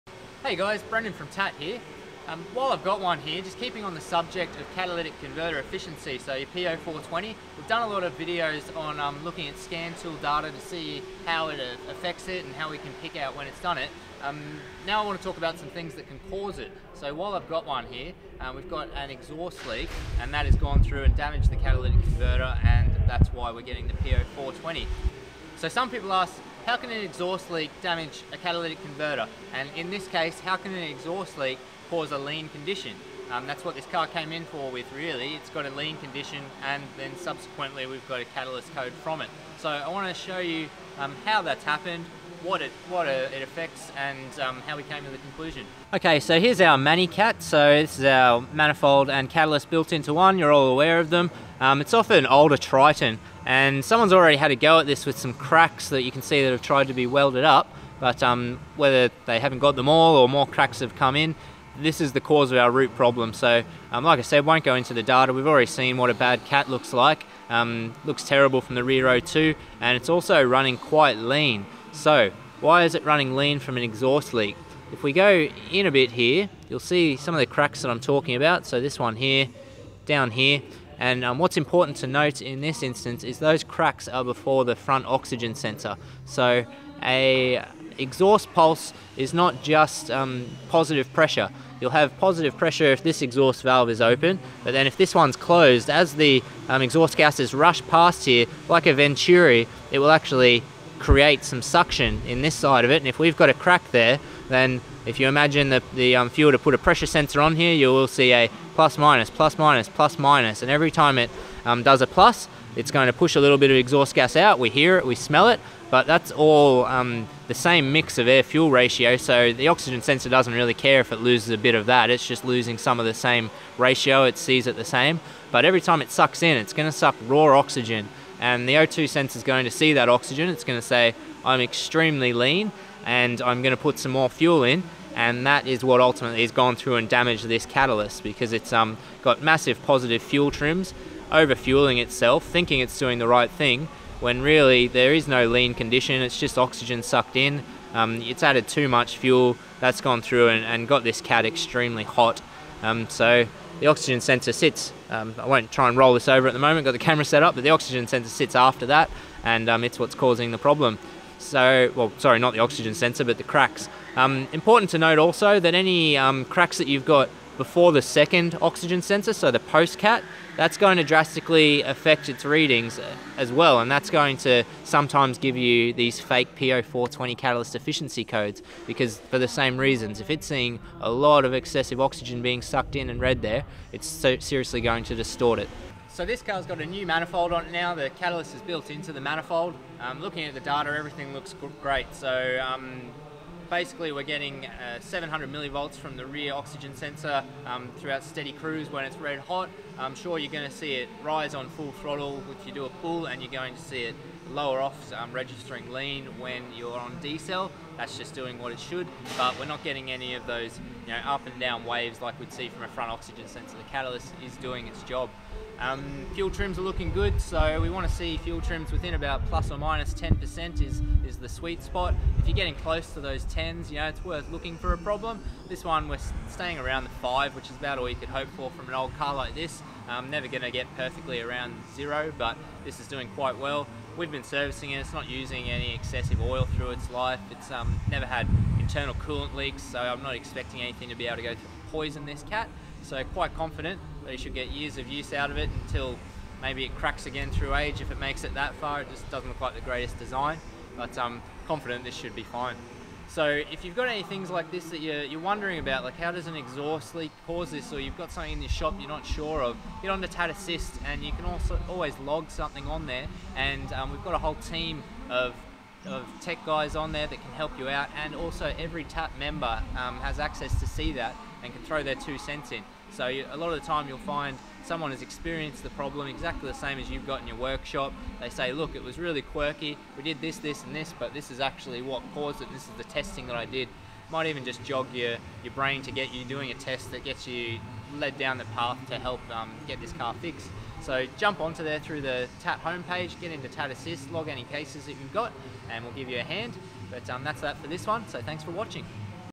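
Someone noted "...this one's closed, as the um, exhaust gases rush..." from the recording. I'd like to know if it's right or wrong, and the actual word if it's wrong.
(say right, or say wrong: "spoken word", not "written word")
right.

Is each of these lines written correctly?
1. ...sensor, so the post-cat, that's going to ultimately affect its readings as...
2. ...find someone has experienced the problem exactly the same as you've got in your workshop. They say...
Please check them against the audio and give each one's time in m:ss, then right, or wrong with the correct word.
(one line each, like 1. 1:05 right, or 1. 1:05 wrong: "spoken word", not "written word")
1. 2:49 wrong: "drastically", not "ultimately"
2. 4:34 right.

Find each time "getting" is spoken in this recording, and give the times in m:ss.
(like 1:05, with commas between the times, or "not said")
0:23, 3:14, 3:29, 3:42.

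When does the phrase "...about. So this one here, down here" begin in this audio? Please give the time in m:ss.
1:18.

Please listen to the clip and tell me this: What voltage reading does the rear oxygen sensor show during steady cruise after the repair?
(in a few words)
700 millivolts.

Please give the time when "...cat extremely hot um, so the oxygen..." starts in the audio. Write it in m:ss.
2:31.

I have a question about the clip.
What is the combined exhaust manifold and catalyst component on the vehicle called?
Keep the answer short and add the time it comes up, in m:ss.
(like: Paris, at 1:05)
ManiCat, at 0:46.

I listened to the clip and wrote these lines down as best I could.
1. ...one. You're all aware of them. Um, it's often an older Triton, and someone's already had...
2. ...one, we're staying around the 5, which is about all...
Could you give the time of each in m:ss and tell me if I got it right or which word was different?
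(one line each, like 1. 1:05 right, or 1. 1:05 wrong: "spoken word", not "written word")
1. 0:50 right
2. 3:45 right.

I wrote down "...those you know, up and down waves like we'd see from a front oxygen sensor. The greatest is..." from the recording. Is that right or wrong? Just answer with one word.
wrong.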